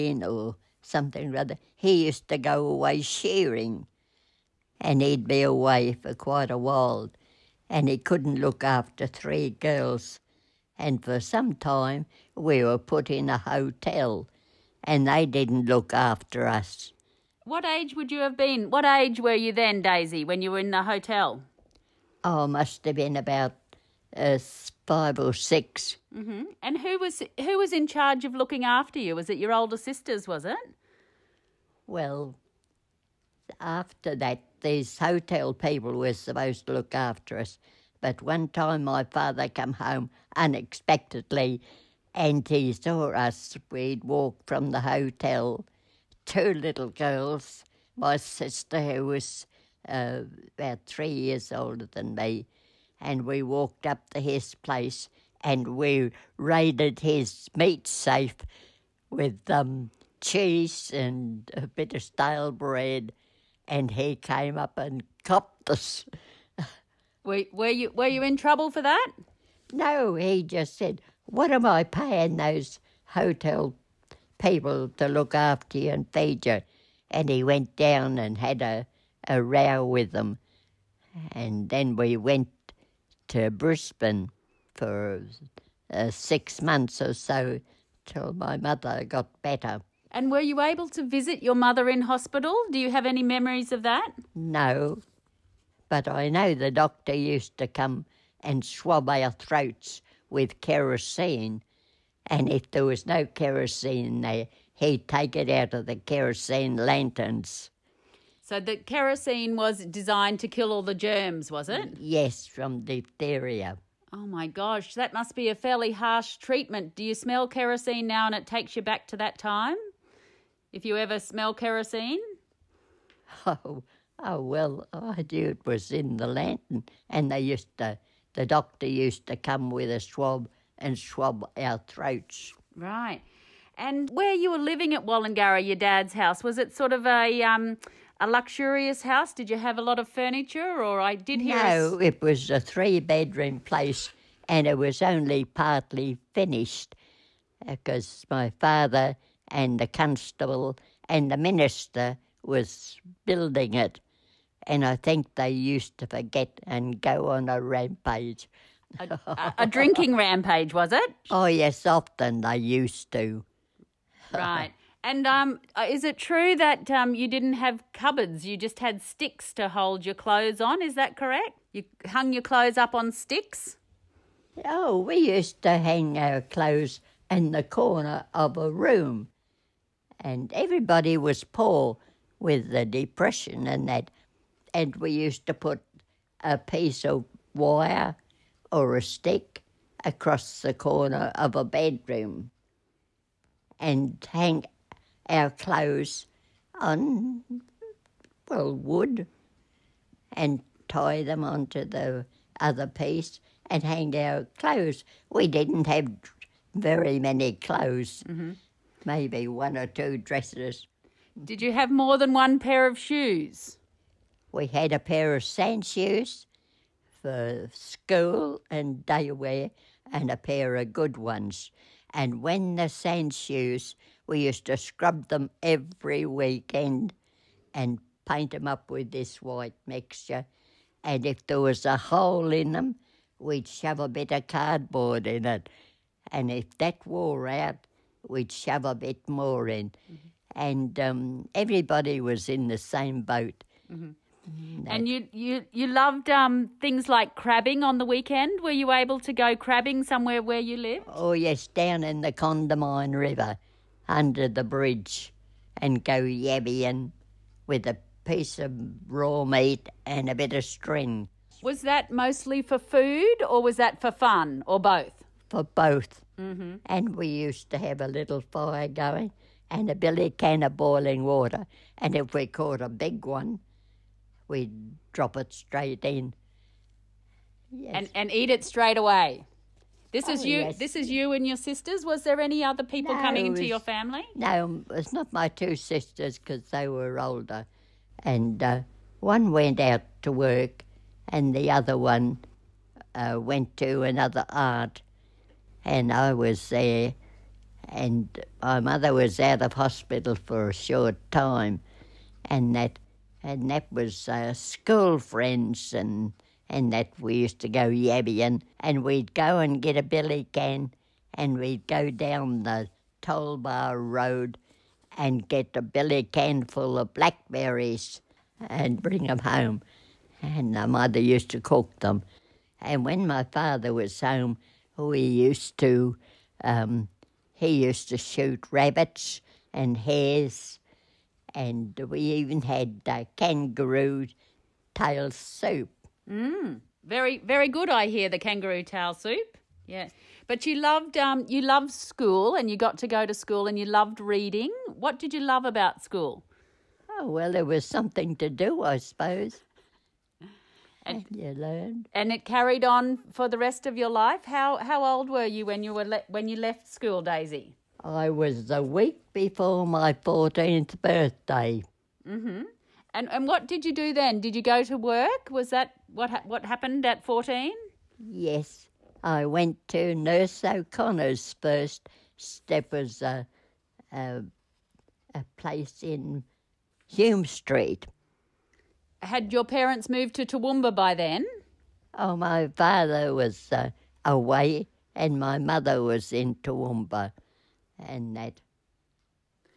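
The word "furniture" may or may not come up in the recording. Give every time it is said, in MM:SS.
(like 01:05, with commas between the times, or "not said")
02:20.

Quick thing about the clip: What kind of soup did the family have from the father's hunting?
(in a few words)
Kangaroo tail soup.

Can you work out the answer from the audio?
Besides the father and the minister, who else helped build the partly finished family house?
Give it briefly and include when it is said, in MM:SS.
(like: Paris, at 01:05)
The constable, at 02:29.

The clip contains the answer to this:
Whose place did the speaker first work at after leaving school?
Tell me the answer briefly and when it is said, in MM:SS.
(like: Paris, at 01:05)
Nurse O'Connor's, at 06:10.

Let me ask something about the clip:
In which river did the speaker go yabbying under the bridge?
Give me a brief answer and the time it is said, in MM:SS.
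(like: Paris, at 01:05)
Condamine River, at 04:12.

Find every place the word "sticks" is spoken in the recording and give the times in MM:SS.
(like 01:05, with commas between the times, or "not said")
02:49, 02:53, 03:09.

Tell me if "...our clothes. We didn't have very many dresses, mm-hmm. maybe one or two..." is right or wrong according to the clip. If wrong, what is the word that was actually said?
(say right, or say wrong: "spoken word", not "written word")
wrong: "clothes", not "dresses".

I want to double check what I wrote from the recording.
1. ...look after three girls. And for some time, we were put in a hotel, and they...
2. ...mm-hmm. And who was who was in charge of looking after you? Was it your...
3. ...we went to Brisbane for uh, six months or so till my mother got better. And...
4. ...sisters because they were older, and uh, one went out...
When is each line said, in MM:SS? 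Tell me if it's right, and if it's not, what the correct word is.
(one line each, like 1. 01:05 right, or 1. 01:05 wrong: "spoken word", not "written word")
1. 00:08 right
2. 00:26 right
3. 01:21 right
4. 04:45 right.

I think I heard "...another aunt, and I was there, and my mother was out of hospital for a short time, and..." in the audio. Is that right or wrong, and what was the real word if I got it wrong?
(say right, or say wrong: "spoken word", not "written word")
right.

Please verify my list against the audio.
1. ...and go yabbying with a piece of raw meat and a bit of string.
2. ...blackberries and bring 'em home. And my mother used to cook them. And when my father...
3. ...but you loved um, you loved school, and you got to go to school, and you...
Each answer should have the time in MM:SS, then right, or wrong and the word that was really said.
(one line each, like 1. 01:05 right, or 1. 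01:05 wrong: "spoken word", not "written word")
1. 04:15 right
2. 05:17 right
3. 05:40 right.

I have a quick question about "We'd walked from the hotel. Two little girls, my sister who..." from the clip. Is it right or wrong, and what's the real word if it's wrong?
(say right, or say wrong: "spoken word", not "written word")
right.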